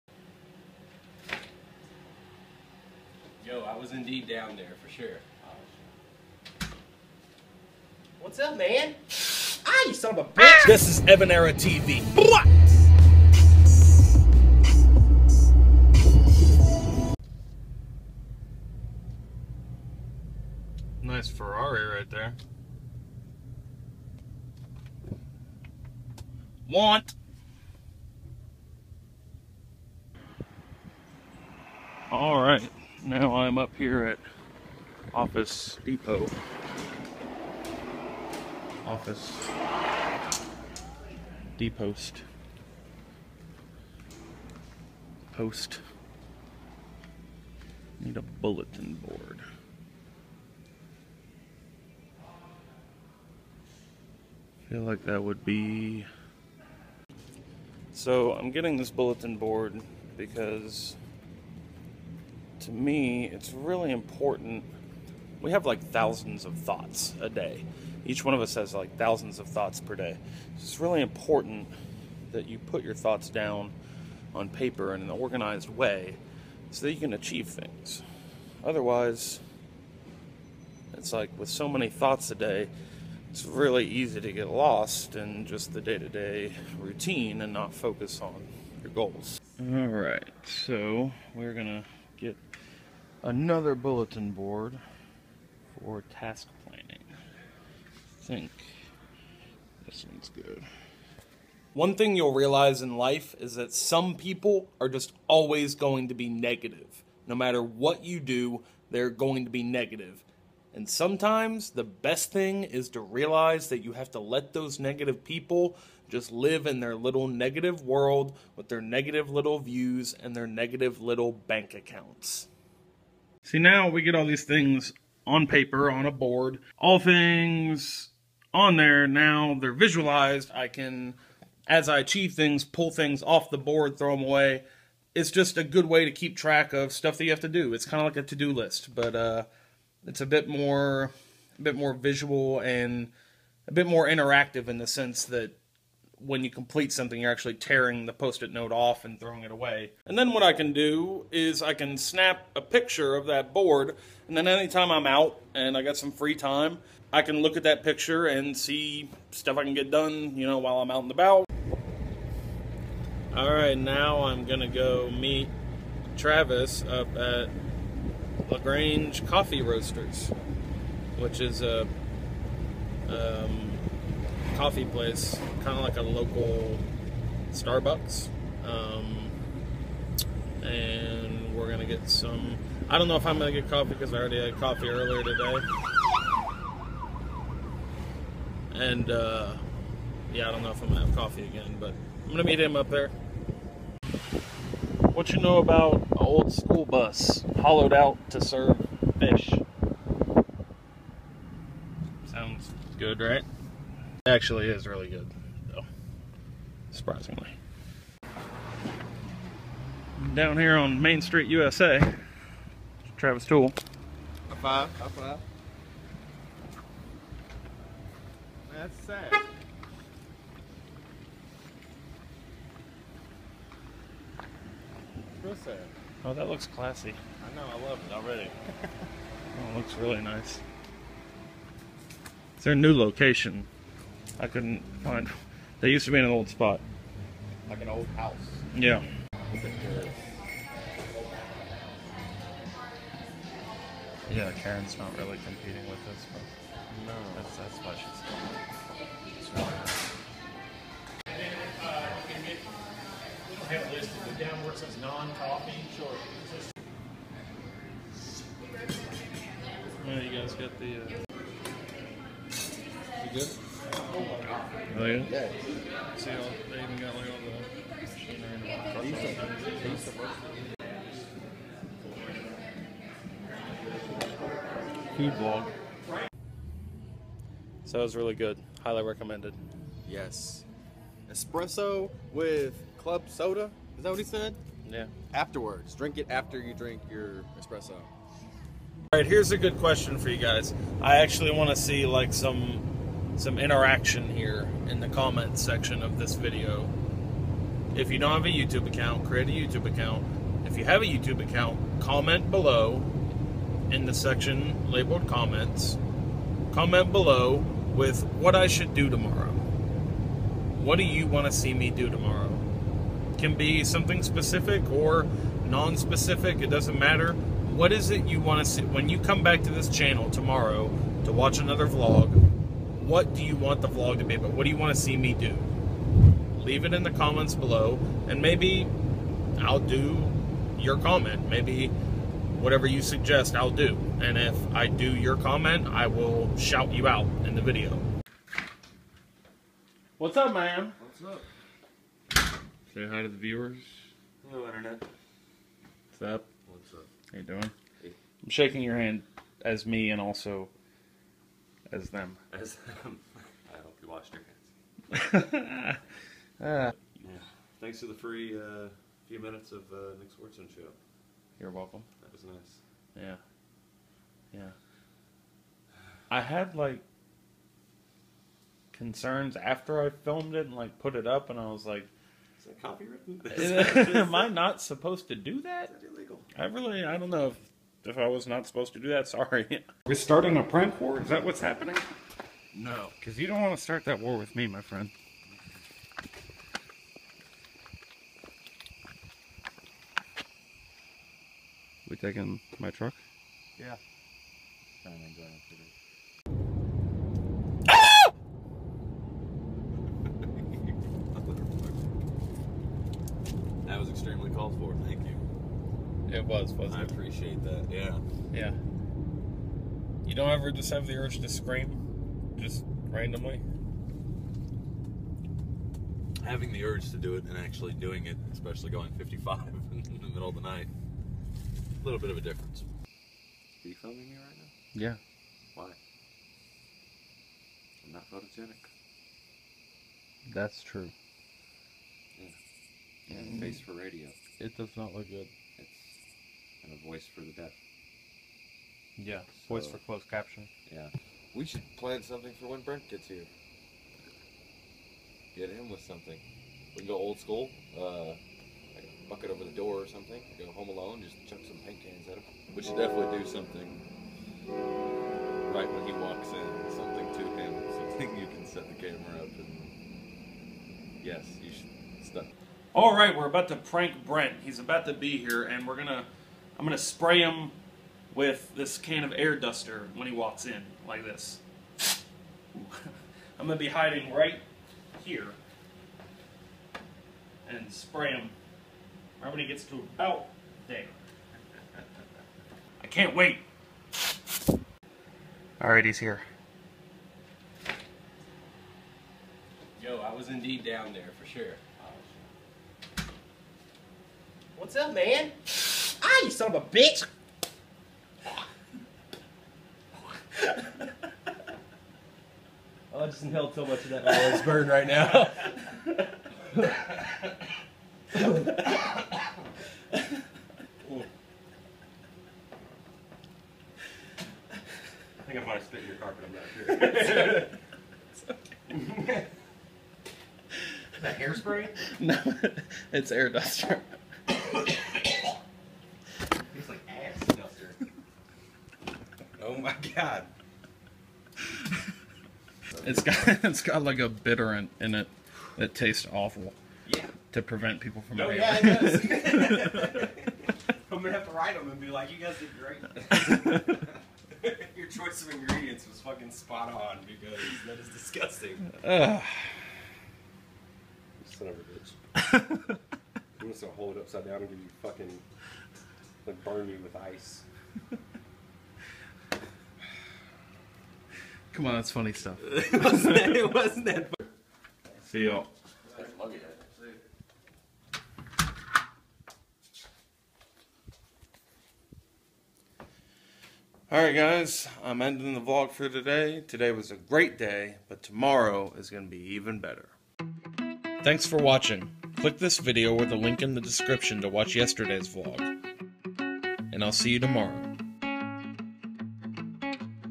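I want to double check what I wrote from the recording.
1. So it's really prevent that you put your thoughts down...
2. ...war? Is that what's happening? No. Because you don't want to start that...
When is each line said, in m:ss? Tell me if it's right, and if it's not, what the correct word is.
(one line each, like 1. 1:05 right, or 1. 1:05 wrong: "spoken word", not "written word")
1. 1:10 wrong: "important", not "prevent"
2. 6:21 right.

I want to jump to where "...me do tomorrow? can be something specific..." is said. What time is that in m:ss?
5:11.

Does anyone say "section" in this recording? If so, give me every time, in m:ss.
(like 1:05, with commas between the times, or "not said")
4:55, 5:04.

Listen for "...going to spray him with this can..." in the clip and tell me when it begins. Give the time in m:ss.
7:46.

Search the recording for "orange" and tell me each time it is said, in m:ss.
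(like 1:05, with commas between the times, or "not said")
not said.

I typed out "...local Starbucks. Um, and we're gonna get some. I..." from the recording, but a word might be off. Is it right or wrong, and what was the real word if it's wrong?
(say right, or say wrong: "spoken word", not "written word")
right.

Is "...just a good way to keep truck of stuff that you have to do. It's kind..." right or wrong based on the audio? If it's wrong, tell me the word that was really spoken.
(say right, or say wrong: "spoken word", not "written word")
wrong: "track", not "truck".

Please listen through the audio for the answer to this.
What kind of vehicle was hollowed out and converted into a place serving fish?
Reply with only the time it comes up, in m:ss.
3:16.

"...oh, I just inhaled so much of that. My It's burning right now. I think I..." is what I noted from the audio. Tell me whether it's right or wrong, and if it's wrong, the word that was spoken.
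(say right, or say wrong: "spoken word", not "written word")
right.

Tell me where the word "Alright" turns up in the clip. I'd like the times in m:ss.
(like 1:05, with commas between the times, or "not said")
8:05, 9:34.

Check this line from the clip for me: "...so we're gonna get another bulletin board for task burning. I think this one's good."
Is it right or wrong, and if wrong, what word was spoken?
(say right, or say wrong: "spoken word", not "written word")
wrong: "planning", not "burning".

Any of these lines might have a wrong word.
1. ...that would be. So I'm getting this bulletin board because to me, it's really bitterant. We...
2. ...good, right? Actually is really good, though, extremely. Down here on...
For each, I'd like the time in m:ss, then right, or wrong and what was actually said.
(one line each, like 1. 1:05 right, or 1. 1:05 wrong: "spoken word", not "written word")
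1. 0:55 wrong: "important", not "bitterant"
2. 3:22 wrong: "surprisingly", not "extremely".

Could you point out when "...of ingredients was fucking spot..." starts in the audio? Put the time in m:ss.
9:05.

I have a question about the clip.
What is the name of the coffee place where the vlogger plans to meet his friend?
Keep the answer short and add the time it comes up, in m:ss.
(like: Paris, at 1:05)
Lagrange Coffee Roasters, at 2:48.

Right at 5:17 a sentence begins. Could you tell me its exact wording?
What is it you want to see when you come back to this channel tomorrow to watch another vlog?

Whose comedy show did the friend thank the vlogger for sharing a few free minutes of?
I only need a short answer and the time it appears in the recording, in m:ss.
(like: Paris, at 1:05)
Nick Swardson, at 6:00.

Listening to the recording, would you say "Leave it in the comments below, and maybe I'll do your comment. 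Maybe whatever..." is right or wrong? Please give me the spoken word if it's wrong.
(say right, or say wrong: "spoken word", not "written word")
right.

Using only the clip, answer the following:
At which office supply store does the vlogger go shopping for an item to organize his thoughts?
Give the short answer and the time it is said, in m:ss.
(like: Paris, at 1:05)
Office Depot, at 0:35.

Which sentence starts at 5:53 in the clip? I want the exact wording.
I hope you washed your hands.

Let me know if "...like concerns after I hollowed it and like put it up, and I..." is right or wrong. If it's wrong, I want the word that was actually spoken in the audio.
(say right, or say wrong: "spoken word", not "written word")
wrong: "filmed", not "hollowed".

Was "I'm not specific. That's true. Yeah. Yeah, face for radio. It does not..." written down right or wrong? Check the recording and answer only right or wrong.
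wrong.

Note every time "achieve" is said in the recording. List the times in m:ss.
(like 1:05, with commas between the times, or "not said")
1:17, 2:11.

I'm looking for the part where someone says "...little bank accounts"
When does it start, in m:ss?
2:01.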